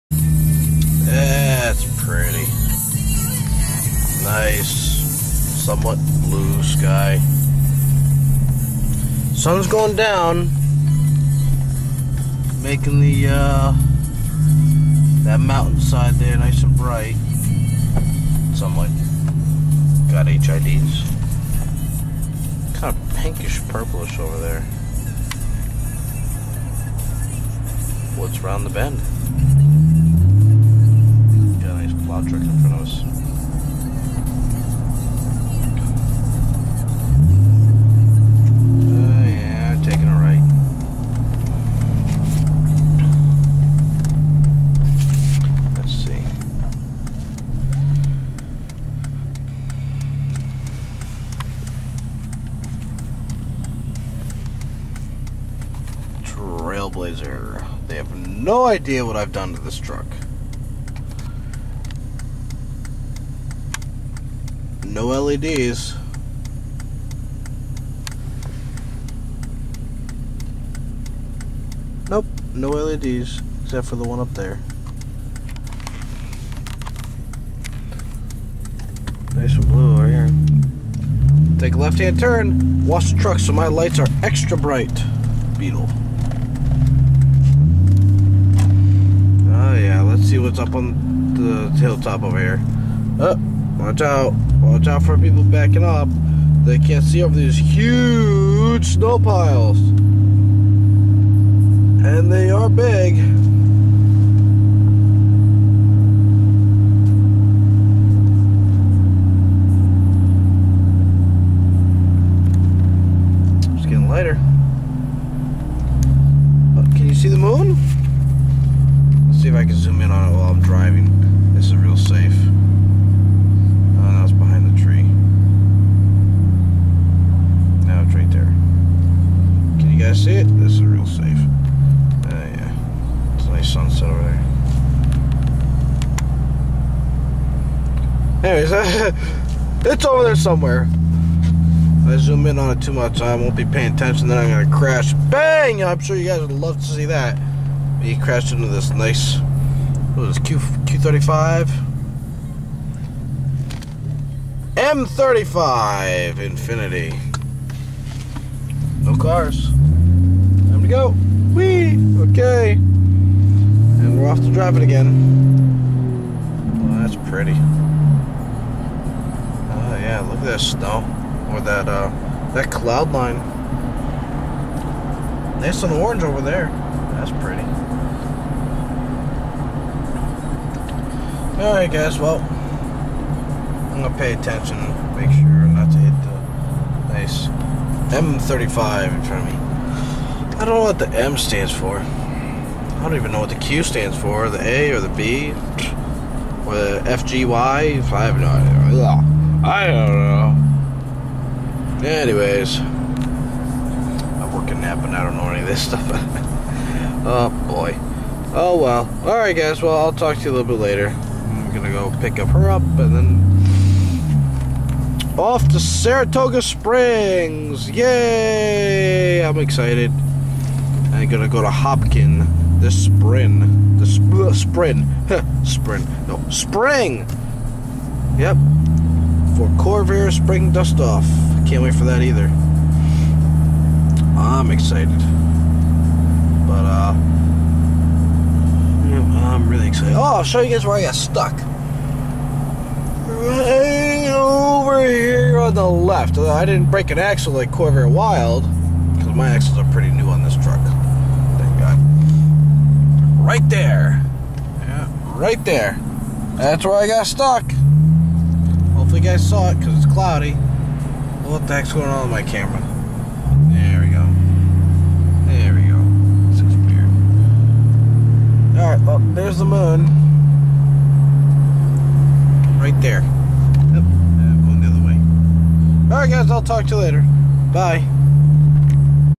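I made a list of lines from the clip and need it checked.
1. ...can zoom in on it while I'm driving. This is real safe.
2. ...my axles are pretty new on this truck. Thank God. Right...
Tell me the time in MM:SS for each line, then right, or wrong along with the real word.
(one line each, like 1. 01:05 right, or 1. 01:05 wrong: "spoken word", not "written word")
1. 01:59 right
2. 04:09 right.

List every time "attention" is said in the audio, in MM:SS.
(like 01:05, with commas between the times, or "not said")
02:23, 03:04.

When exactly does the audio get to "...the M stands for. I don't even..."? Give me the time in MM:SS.
03:10.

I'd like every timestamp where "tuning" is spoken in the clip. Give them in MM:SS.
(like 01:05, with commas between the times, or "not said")
not said.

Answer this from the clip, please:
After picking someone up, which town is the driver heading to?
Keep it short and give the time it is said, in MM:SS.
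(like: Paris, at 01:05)
Saratoga Springs, at 03:35.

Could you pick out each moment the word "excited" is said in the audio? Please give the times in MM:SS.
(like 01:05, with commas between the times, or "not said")
03:39, 03:54, 03:59.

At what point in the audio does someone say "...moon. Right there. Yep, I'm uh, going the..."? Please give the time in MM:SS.
04:29.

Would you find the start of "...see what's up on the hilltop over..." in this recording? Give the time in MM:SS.
01:30.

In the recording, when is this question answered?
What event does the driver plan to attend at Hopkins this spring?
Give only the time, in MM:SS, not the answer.
03:49.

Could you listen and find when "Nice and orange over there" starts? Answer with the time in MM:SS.
02:55.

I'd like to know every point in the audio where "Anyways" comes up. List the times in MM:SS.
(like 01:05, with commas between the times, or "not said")
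02:18, 03:22.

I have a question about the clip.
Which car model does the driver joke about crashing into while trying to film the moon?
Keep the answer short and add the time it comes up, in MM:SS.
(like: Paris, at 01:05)
M35 Infiniti, at 02:34.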